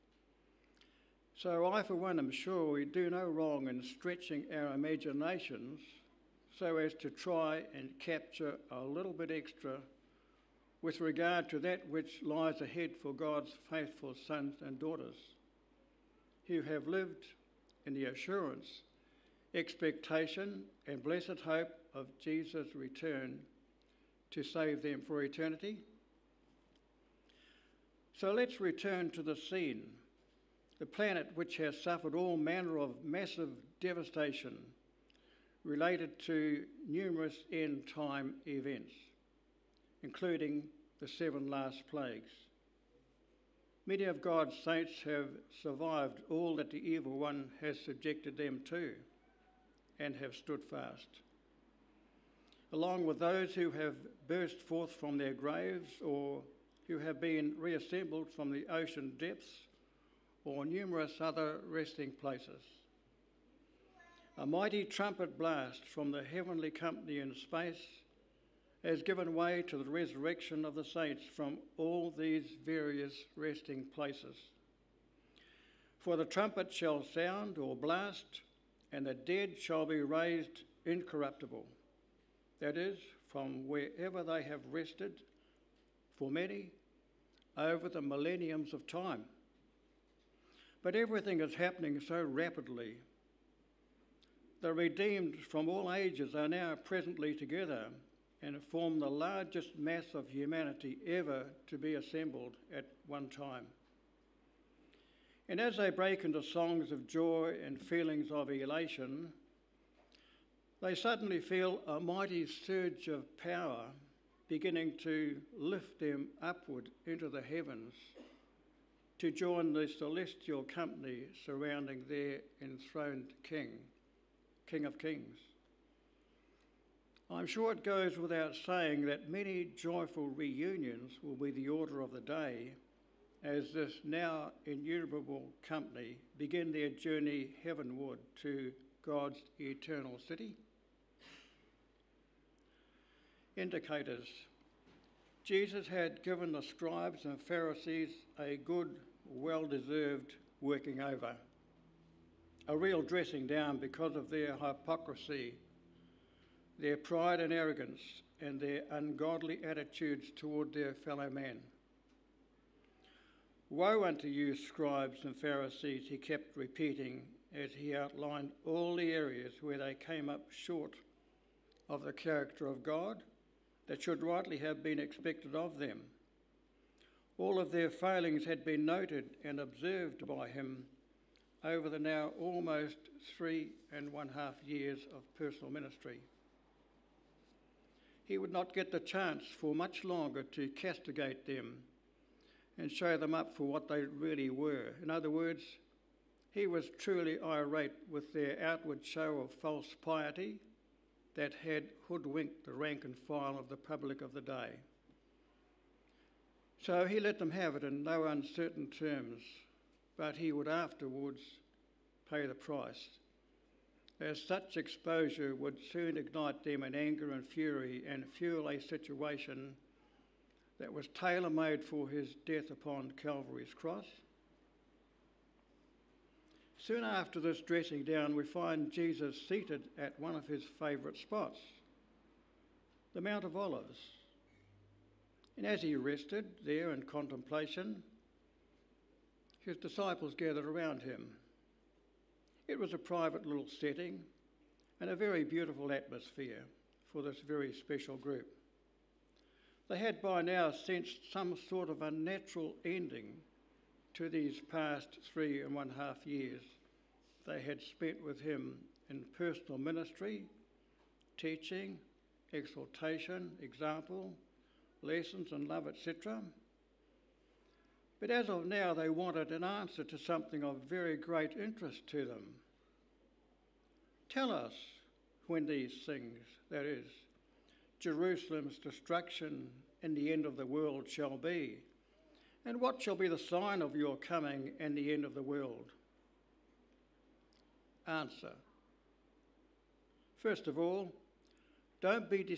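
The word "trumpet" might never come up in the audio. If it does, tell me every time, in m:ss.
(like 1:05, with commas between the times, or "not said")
1:04, 1:16.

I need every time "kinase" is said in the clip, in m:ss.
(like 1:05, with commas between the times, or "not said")
not said.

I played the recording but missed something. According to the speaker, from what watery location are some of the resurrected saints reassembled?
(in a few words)
the ocean depths.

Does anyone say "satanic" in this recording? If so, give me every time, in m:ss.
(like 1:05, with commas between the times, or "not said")
not said.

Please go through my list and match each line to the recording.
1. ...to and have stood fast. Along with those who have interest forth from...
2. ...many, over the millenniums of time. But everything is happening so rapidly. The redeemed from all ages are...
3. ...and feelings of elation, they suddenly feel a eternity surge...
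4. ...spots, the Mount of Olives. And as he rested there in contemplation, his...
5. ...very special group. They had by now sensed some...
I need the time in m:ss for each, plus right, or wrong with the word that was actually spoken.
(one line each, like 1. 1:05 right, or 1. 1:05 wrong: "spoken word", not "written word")
1. 0:48 wrong: "burst", not "interest"
2. 1:26 right
3. 1:47 wrong: "mighty", not "eternity"
4. 3:51 right
5. 4:07 right.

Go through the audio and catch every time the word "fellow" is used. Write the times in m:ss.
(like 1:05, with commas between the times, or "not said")
2:40.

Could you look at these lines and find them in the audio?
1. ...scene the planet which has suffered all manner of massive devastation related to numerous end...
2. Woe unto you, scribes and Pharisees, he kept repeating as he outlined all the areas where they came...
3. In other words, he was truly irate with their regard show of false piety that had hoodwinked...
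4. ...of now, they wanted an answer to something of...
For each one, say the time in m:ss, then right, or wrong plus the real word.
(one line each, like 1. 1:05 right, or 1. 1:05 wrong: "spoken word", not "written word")
1. 0:29 right
2. 2:43 right
3. 3:15 wrong: "outward", not "regard"
4. 4:28 right.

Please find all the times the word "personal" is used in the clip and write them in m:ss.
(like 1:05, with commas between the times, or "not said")
3:05, 4:19.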